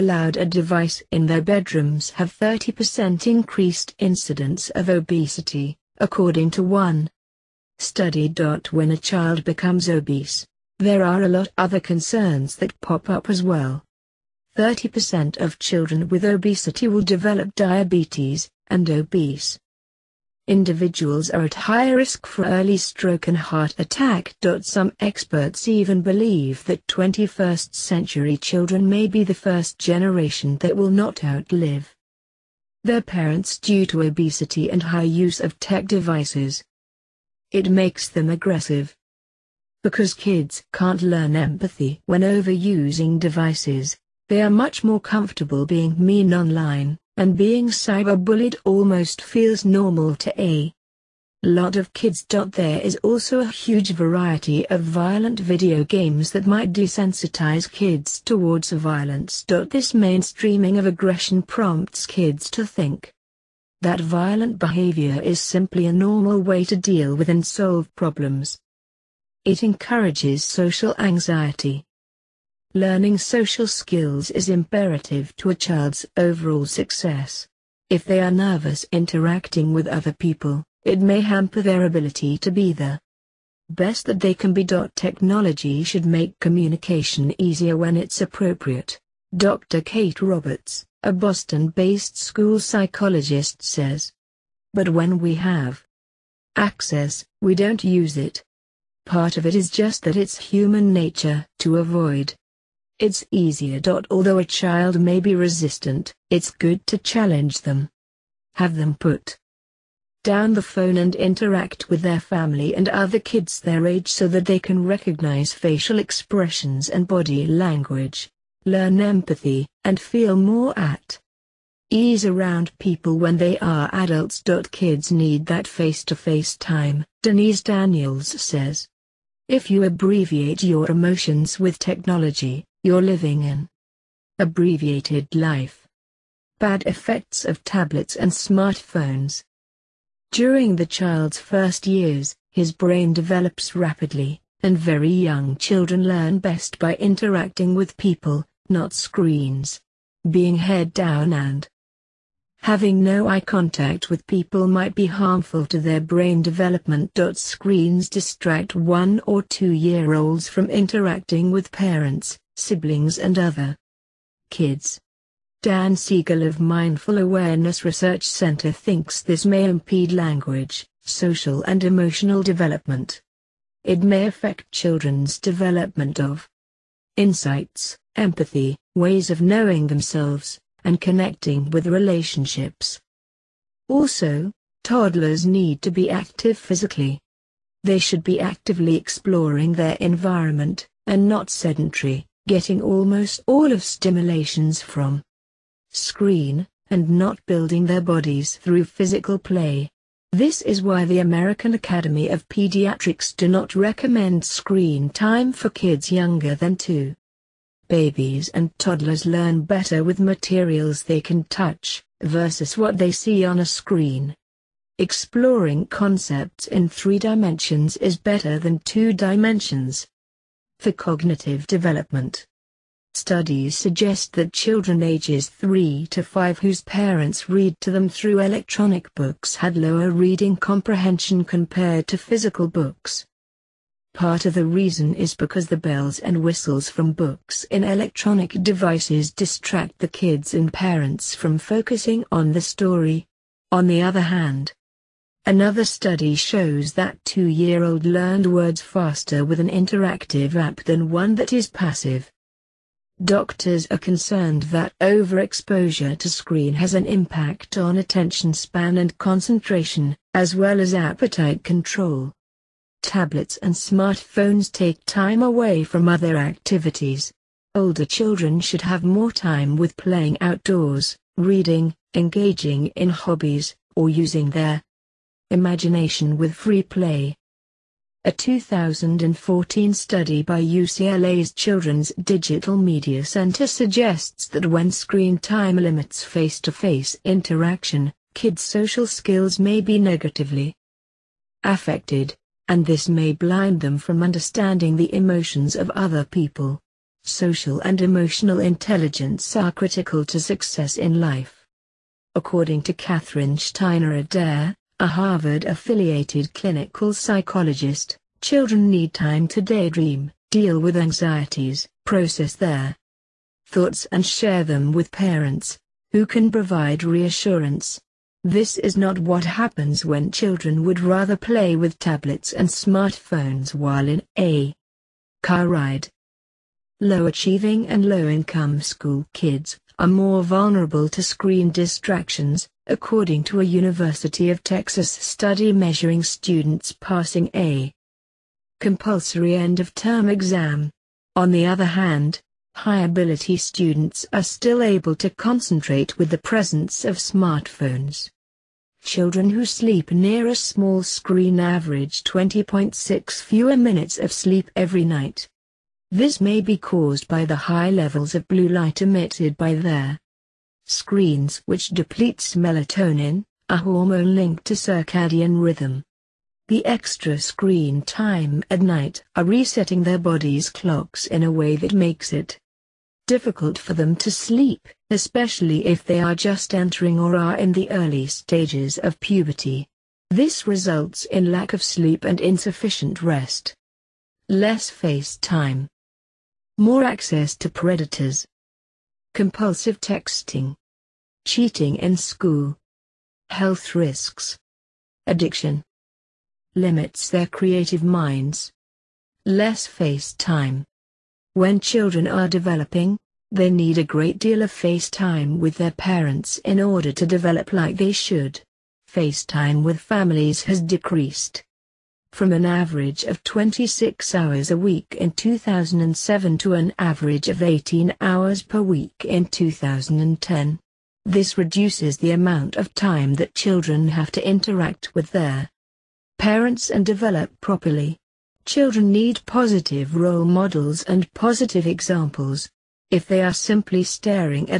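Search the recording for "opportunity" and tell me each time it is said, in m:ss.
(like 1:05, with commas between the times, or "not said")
not said.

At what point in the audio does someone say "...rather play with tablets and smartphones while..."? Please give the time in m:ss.
5:20.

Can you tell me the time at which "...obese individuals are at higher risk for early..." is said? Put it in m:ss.
0:18.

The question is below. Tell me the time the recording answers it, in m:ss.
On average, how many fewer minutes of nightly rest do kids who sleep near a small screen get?
5:52.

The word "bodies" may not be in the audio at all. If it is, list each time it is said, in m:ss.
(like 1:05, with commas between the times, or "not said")
3:18.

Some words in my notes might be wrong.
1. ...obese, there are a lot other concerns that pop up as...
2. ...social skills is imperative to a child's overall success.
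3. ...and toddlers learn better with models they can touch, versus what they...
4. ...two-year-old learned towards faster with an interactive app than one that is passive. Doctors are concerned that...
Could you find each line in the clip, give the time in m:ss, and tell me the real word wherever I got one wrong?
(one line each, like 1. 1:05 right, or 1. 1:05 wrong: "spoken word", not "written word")
1. 0:09 right
2. 1:13 right
3. 3:28 wrong: "materials", not "models"
4. 4:07 wrong: "words", not "towards".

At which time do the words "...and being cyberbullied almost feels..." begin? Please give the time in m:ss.
0:47.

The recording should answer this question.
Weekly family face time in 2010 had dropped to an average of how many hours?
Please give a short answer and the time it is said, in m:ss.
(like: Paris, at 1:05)
18, at 6:57.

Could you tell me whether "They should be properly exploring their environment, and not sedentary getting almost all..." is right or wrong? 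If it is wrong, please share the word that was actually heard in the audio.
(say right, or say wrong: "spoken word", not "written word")
wrong: "actively", not "properly".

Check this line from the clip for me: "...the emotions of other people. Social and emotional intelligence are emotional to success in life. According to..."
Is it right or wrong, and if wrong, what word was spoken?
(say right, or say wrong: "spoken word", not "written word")
wrong: "critical", not "emotional".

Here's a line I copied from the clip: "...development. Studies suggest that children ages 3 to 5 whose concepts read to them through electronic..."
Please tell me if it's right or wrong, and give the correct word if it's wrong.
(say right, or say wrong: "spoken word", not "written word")
wrong: "parents", not "concepts".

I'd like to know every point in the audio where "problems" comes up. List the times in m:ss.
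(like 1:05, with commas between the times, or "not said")
1:07.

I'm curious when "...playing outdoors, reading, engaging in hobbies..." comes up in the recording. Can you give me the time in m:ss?
4:29.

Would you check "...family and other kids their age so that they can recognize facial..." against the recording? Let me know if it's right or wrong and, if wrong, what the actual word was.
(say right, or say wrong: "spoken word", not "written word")
right.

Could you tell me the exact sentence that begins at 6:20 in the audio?
This results in lack of sleep and insufficient rest.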